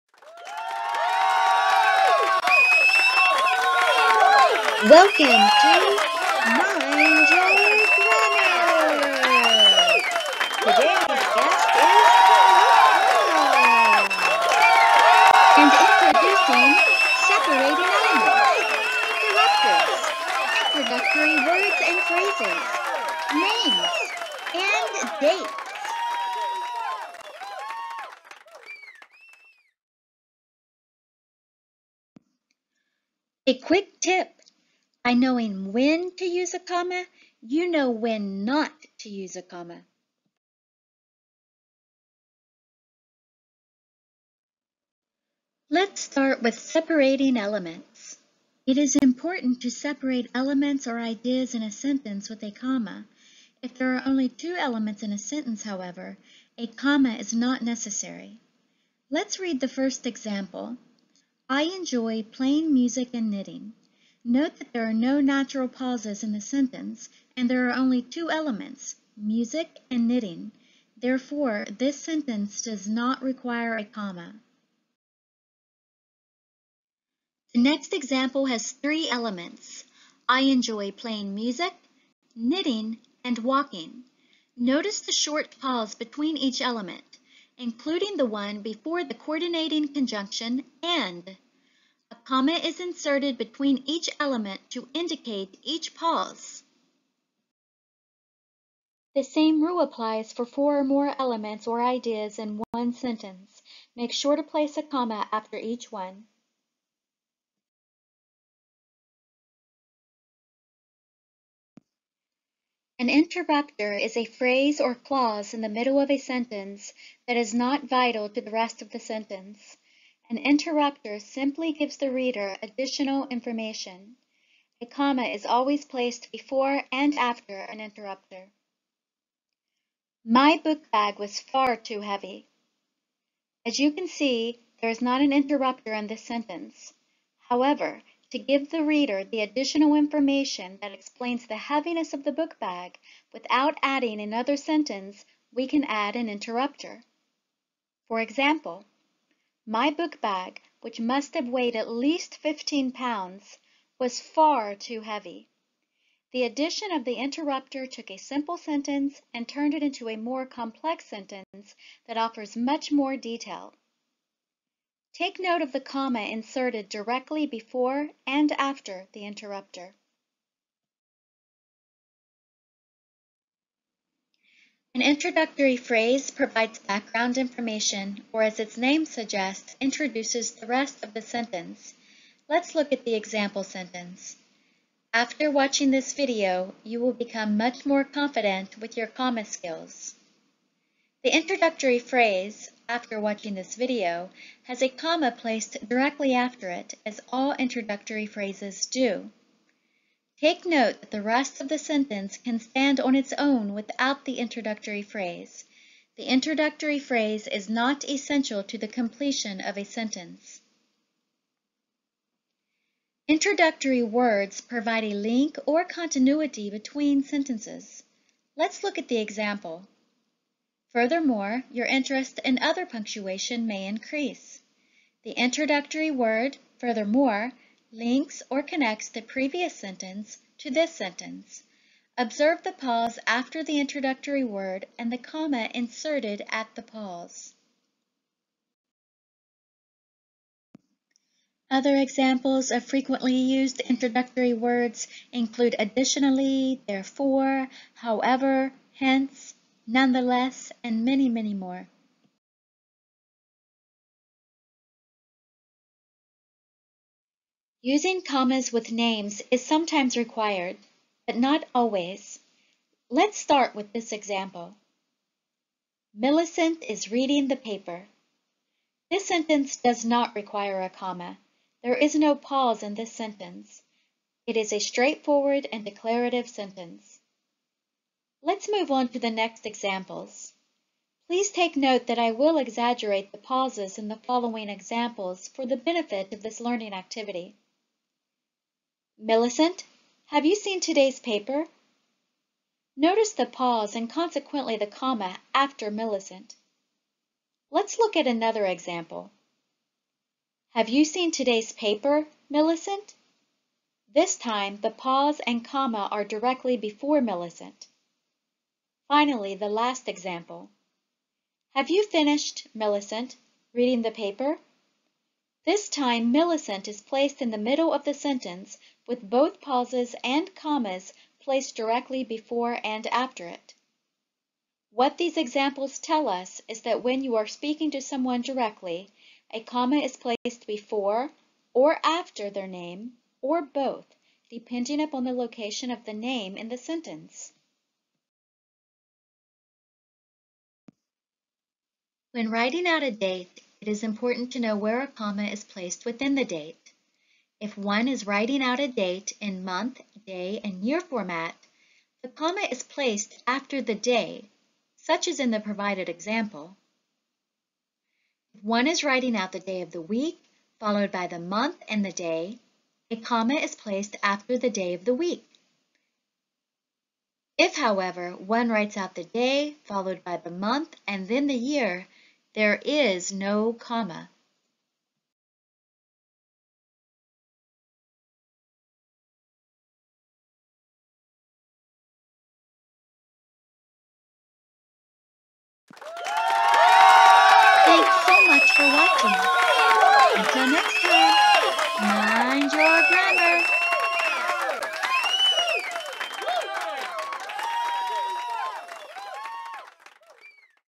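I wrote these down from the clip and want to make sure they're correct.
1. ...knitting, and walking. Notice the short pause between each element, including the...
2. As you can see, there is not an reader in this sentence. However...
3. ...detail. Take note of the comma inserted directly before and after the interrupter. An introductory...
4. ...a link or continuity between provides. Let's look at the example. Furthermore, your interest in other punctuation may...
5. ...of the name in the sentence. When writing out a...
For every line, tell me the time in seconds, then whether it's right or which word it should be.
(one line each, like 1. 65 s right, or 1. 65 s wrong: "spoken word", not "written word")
1. 82 s right
2. 133 s wrong: "interrupter", not "reader"
3. 163 s right
4. 215 s wrong: "sentences", not "provides"
5. 335 s right.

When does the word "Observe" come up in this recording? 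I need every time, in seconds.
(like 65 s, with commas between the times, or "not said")
232 s.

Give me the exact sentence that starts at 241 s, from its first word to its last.
Other examples of frequently used introductory words include additionally, therefore, however, hence, nonetheless, and many, many more.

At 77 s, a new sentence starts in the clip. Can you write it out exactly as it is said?
The next example has three elements.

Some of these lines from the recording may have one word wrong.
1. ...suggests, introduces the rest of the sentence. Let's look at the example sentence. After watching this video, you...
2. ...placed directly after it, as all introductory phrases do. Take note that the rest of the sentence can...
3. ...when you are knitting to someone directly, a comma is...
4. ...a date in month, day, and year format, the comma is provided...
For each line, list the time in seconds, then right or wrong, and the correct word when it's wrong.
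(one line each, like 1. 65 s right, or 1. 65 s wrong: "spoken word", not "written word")
1. 179 s right
2. 195 s right
3. 327 s wrong: "speaking", not "knitting"
4. 348 s wrong: "placed", not "provided".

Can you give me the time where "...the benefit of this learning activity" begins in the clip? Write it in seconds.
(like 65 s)
285 s.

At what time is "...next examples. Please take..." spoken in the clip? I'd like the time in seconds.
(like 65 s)
279 s.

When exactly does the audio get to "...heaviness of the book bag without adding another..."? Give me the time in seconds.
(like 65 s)
141 s.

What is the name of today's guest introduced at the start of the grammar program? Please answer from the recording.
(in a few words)
Carl.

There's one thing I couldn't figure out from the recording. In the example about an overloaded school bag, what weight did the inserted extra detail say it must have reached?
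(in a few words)
15 pounds.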